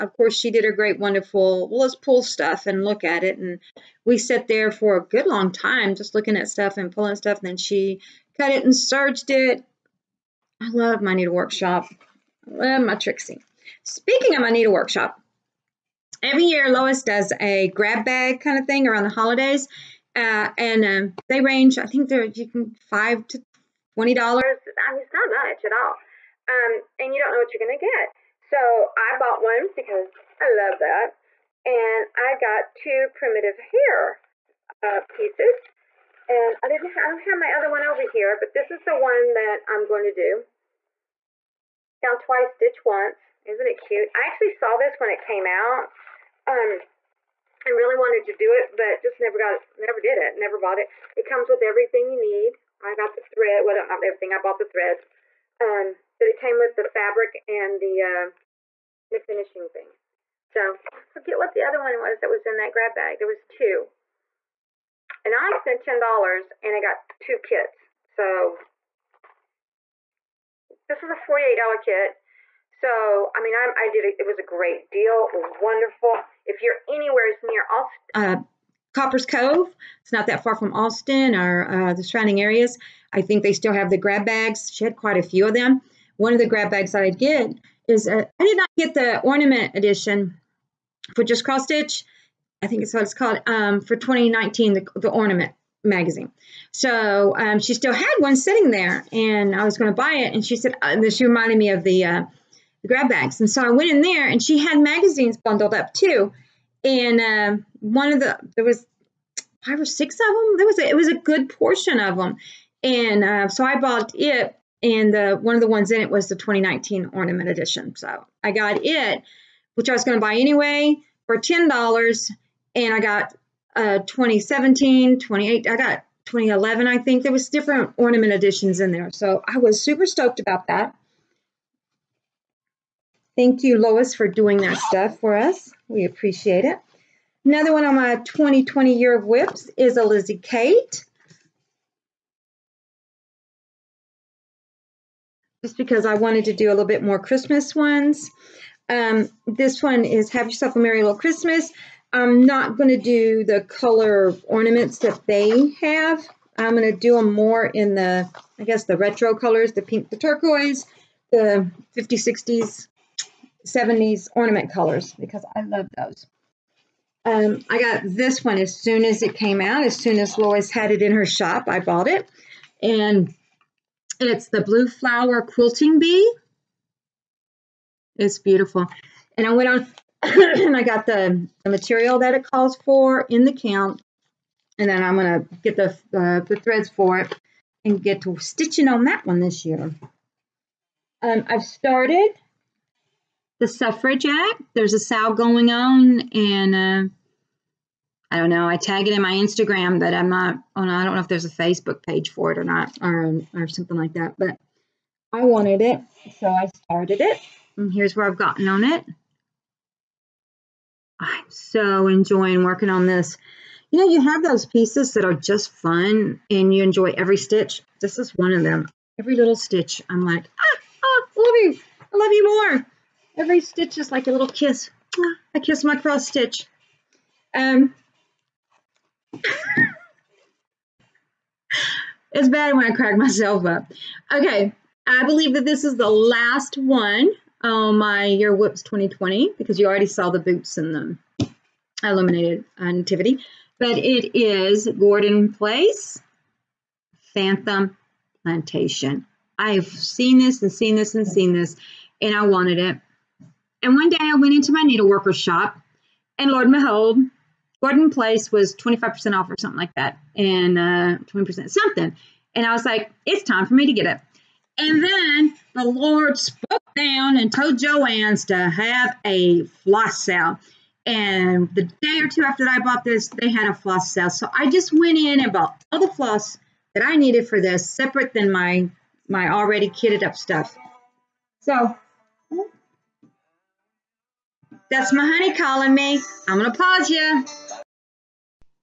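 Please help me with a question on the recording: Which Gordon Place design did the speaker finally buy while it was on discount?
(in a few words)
Phantom Plantation.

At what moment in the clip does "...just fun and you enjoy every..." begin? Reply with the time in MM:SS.
03:35.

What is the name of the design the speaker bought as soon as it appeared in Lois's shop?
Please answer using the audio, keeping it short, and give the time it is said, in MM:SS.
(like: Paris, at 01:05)
Blue Flower Quilting Bee, at 02:54.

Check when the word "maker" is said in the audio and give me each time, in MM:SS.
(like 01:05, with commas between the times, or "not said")
not said.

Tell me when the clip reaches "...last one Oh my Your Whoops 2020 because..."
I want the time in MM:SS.
03:56.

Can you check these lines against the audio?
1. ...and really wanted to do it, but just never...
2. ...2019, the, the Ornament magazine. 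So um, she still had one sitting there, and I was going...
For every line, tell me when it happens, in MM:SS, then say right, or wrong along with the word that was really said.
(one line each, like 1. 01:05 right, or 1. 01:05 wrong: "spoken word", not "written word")
1. 00:47 right
2. 01:33 right.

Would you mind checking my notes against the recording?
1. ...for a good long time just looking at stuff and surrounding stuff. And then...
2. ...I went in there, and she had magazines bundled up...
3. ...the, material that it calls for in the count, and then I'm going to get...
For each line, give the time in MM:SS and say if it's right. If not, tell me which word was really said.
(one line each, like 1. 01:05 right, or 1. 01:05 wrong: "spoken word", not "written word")
1. 00:04 wrong: "pulling", not "surrounding"
2. 01:43 right
3. 03:01 right.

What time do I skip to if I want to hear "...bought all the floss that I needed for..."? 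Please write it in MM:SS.
04:35.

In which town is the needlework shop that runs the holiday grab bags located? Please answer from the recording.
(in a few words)
Copperas Cove.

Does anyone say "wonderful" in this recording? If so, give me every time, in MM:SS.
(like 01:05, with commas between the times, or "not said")
00:00, 01:15.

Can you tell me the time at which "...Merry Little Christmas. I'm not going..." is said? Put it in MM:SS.
02:30.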